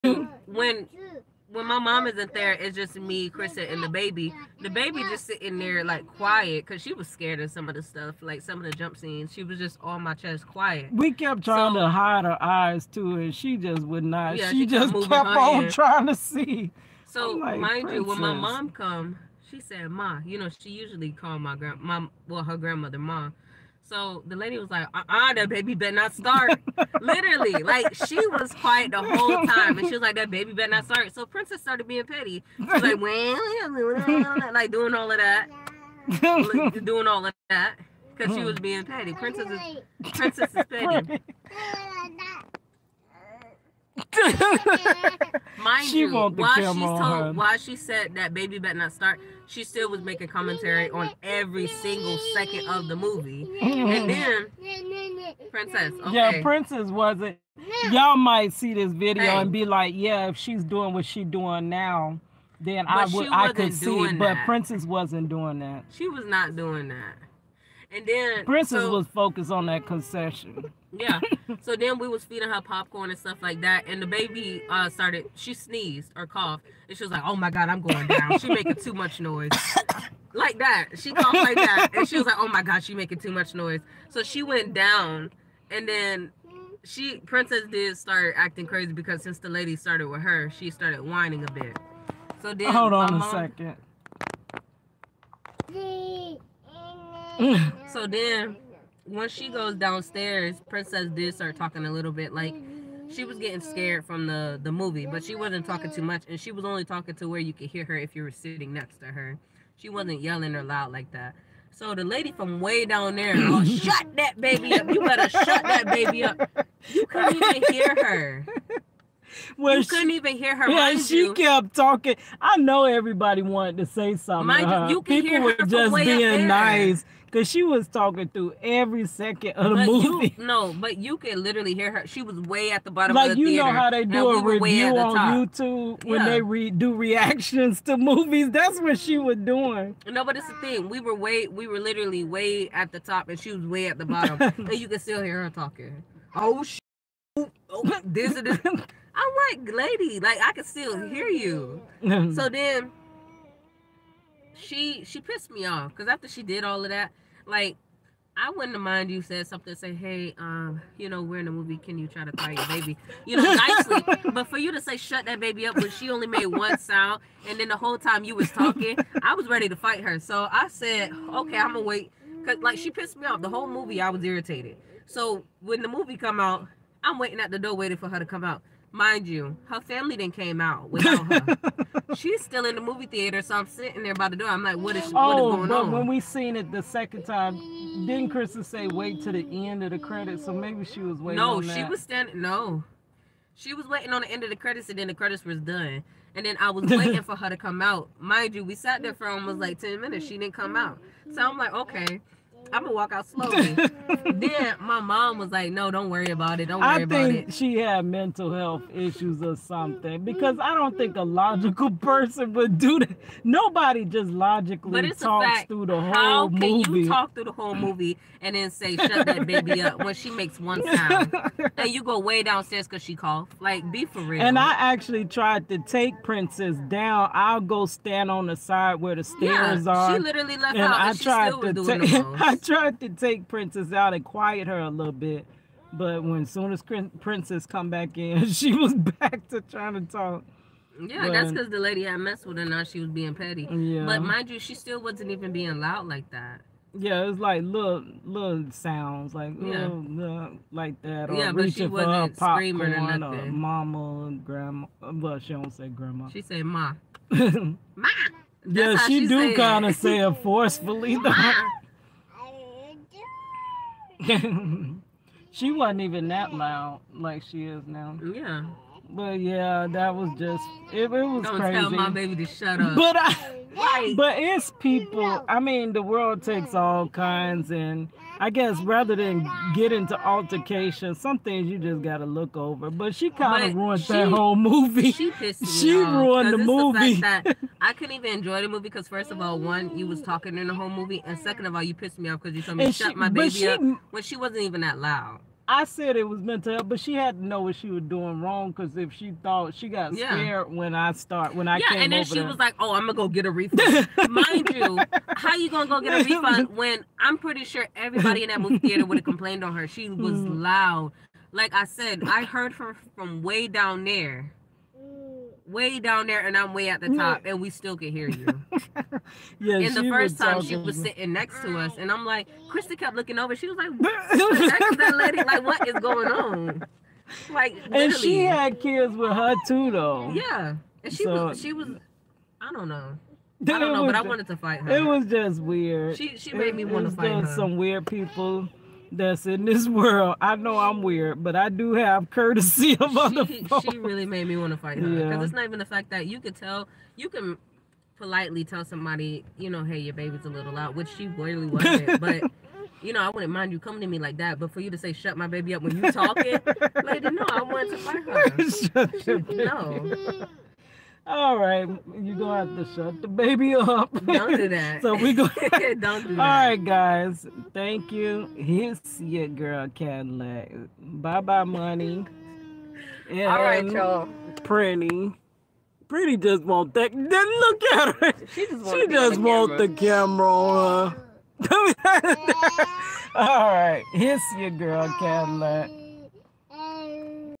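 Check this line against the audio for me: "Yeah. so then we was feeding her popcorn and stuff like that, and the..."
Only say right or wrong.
right.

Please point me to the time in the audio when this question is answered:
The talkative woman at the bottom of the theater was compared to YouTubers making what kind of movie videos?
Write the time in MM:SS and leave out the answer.
02:16.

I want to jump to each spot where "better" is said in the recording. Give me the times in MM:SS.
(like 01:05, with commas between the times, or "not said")
00:25, 00:30, 00:48, 01:55.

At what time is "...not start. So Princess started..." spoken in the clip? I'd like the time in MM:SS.
00:30.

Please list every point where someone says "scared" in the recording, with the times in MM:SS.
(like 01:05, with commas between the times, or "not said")
00:07, 01:43, 05:00.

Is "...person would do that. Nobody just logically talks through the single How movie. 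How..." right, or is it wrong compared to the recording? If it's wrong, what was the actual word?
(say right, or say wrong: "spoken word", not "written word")
wrong: "whole", not "single".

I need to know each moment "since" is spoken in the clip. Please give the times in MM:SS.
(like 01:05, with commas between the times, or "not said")
01:29.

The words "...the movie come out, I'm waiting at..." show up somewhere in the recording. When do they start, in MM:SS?
02:55.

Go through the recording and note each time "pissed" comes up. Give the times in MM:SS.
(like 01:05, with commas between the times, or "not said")
02:35, 02:52, 04:45, 04:51.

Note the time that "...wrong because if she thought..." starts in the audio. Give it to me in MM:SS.
04:58.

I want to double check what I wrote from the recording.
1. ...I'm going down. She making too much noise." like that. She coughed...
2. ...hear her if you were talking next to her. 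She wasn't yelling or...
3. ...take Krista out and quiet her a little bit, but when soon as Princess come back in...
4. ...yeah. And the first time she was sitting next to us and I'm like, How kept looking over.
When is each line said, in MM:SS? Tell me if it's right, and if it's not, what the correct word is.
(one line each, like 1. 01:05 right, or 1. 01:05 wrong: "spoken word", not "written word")
1. 01:17 right
2. 01:47 wrong: "sitting", not "talking"
3. 03:53 wrong: "Princess", not "Krista"
4. 05:19 wrong: "Krista", not "How".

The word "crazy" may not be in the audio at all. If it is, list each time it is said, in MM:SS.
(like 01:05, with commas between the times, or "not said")
01:28, 04:31.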